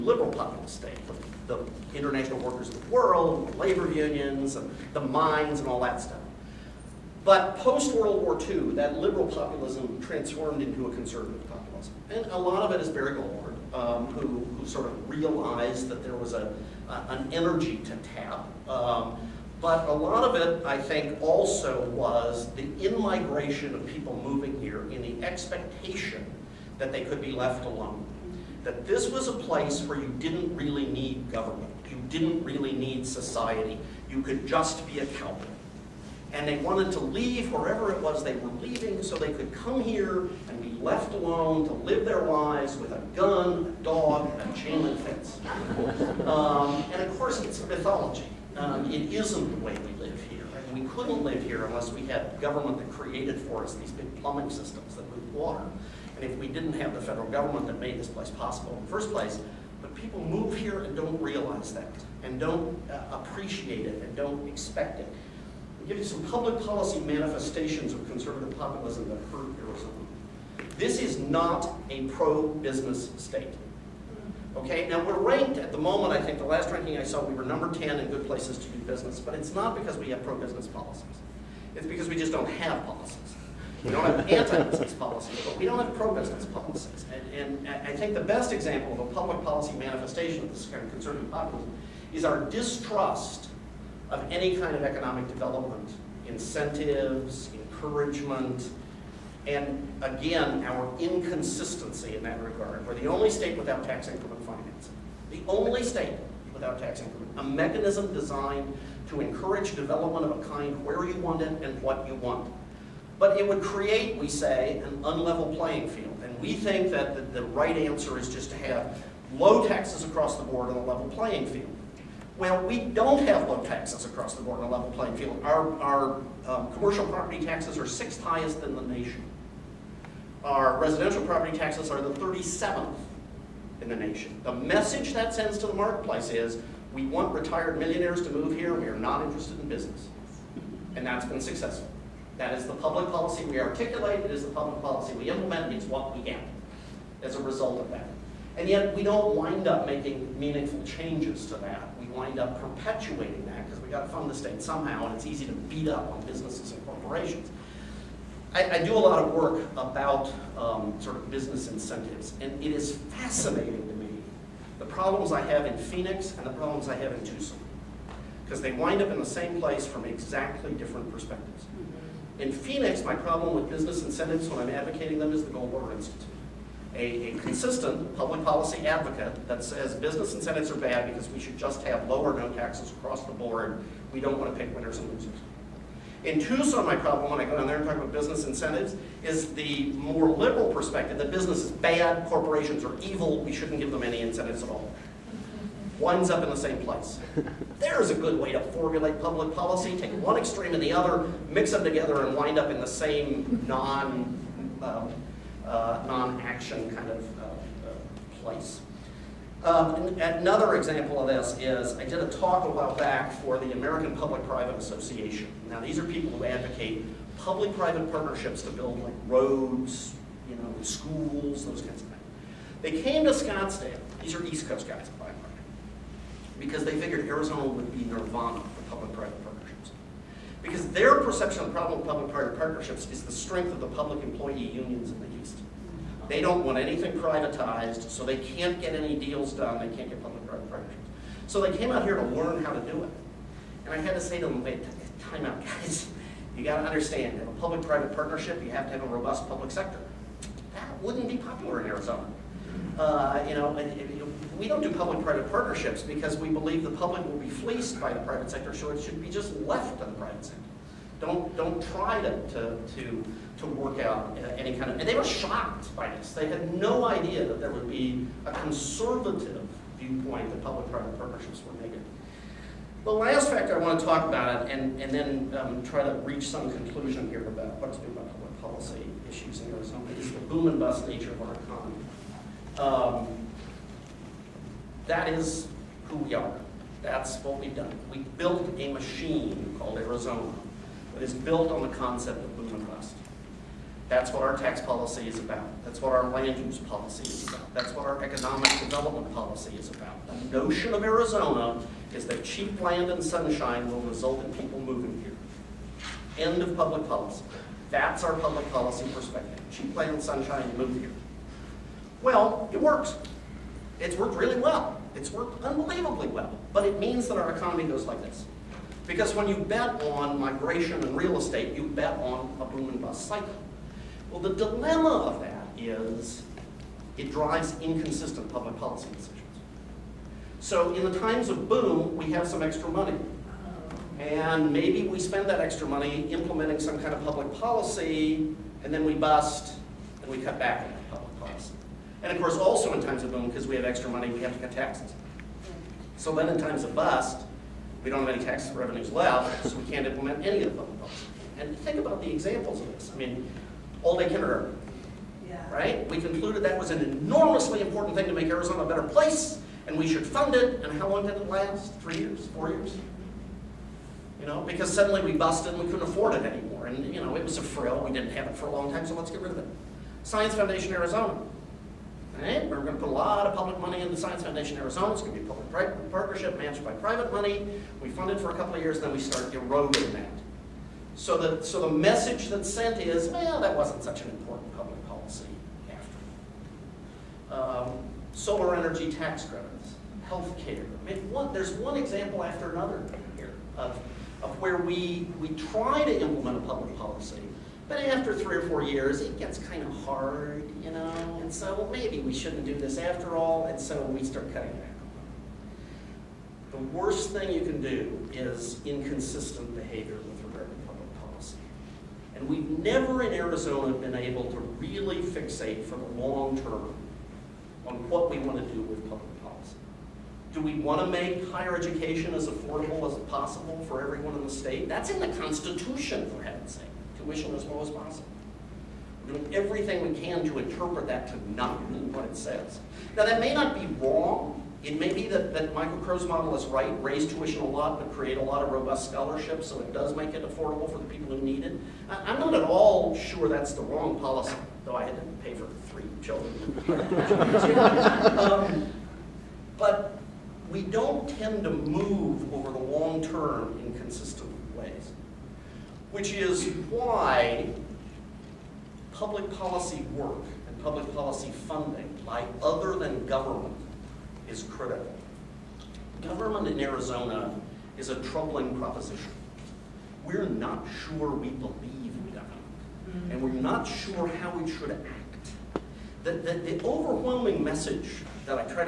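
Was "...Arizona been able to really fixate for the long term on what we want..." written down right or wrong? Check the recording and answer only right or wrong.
right.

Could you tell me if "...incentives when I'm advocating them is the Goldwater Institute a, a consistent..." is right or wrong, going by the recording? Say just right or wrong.
right.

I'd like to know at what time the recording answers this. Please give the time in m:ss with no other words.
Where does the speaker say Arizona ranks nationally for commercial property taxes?
2:07.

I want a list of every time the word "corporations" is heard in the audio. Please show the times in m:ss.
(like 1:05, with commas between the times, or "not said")
2:36, 3:12.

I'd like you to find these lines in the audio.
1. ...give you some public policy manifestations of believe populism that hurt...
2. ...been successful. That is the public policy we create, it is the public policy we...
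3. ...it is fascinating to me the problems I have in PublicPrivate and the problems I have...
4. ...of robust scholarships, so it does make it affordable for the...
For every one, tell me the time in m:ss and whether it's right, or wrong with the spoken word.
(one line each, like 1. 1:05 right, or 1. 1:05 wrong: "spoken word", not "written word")
1. 1:05 wrong: "conservative", not "believe"
2. 2:21 wrong: "articulate", not "create"
3. 2:42 wrong: "Phoenix", not "PublicPrivate"
4. 7:18 right.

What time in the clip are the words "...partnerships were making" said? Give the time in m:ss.
4:31.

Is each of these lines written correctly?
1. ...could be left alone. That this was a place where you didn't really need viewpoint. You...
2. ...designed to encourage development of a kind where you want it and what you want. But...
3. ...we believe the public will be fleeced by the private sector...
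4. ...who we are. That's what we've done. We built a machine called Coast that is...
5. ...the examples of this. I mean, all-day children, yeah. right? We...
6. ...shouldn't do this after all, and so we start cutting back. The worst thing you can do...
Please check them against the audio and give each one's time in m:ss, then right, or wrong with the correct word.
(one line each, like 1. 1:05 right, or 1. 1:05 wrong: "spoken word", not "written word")
1. 0:27 wrong: "government", not "viewpoint"
2. 1:48 right
3. 4:16 right
4. 4:46 wrong: "Arizona", not "Coast"
5. 5:52 wrong: "kindergarten", not "children"
6. 6:42 right.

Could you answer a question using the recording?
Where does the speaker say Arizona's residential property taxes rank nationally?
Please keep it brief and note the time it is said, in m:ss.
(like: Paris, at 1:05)
37th, at 2:12.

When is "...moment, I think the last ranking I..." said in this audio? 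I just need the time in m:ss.
1:15.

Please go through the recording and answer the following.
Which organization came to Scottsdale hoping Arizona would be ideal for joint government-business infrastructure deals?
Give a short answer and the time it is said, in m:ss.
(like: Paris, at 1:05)
American Public-Private Association, at 3:33.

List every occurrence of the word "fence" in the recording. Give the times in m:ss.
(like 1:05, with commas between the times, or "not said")
0:45.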